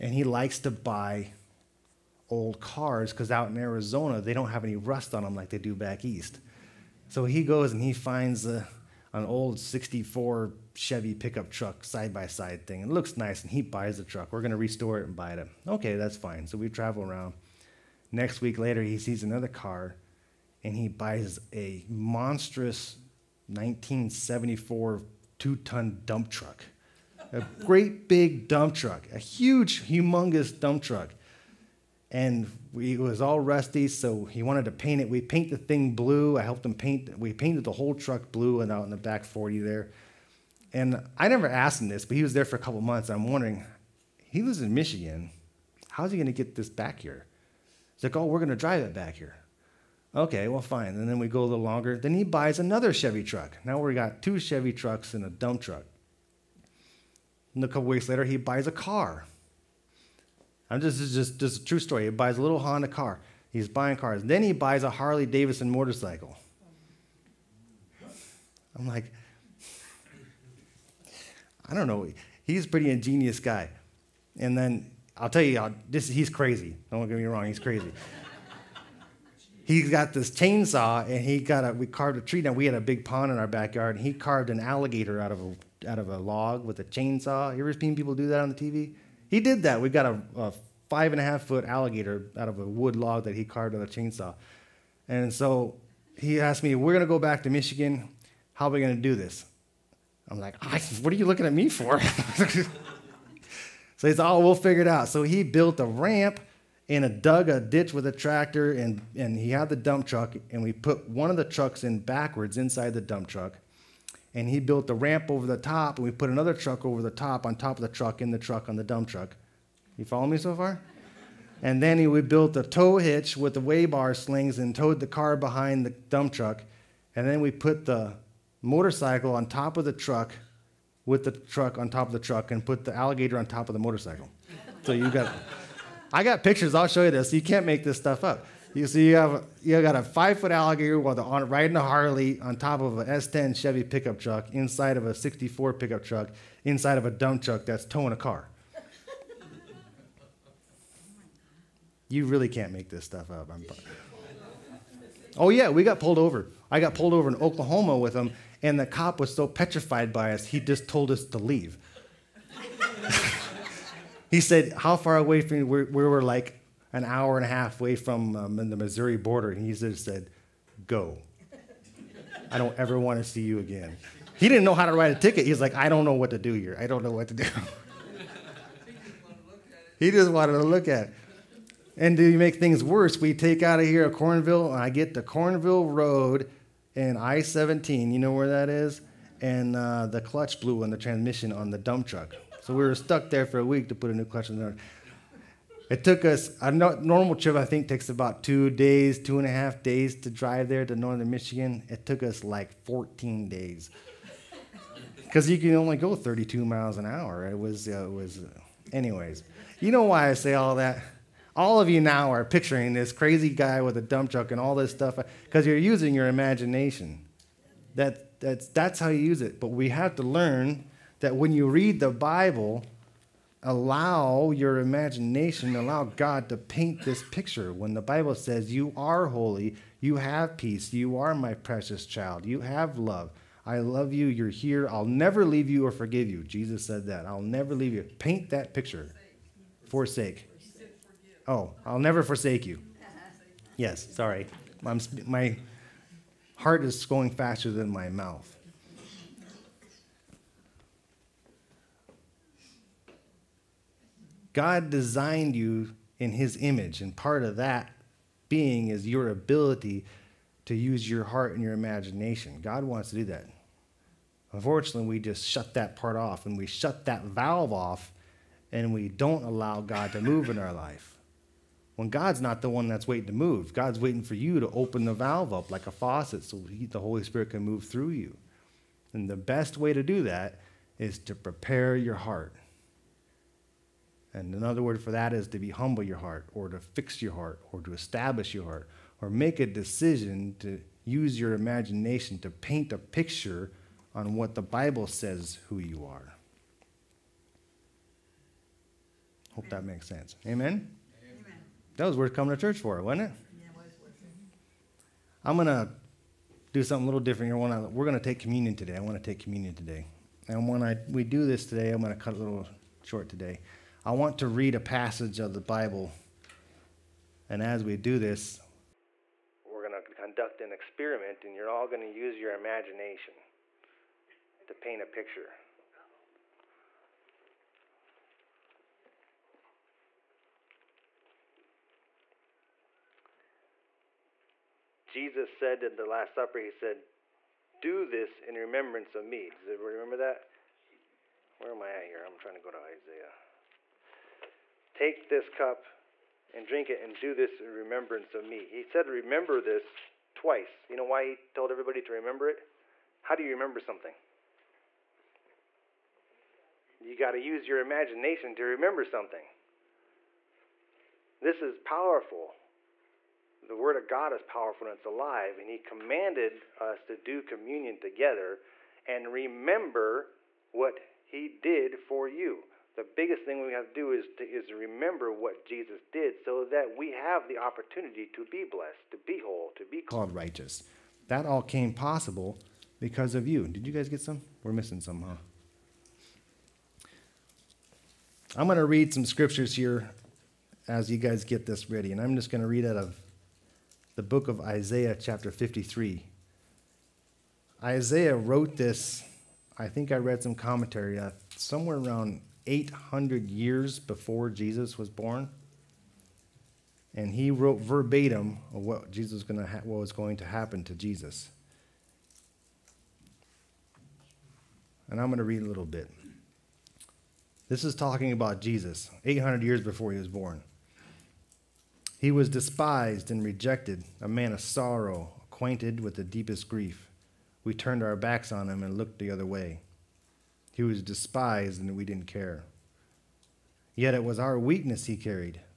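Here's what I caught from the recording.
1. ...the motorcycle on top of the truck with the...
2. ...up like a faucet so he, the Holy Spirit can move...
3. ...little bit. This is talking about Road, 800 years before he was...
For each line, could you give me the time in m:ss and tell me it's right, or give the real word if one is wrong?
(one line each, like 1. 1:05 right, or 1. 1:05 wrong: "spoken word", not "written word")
1. 2:07 right
2. 4:35 right
3. 6:55 wrong: "Jesus", not "Road".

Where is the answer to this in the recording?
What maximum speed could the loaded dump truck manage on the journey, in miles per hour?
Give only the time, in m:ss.
3:26.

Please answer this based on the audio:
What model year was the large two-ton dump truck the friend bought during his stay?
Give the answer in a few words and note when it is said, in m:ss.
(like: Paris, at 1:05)
1974, at 0:23.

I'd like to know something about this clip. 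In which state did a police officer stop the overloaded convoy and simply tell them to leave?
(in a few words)
Oklahoma.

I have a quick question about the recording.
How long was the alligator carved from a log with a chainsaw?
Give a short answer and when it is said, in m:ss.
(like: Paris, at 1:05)
5.5 feet, at 1:30.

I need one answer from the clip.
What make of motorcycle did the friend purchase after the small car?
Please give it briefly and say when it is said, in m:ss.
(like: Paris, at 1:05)
Harley Davidson, at 1:04.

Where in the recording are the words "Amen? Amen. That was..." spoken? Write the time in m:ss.
5:00.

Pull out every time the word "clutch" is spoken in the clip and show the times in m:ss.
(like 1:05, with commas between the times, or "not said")
3:10, 3:14.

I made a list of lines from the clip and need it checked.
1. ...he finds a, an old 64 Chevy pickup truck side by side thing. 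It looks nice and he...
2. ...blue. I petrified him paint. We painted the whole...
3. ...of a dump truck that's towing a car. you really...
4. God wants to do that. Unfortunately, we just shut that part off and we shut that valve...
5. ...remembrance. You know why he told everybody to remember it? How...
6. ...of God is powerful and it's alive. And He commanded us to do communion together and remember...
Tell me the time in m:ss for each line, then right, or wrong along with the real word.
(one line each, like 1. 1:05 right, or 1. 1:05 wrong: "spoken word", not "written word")
1. 0:07 right
2. 0:35 wrong: "helped", not "petrified"
3. 2:26 right
4. 4:22 right
5. 5:50 wrong: "twice", not "remembrance"
6. 6:03 right.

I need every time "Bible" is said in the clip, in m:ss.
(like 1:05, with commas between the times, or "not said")
3:42, 3:48, 4:54, 5:15.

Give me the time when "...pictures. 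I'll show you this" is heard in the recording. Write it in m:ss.
2:16.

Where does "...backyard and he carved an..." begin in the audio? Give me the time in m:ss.
1:23.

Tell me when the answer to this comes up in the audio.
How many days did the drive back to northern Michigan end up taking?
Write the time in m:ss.
3:22.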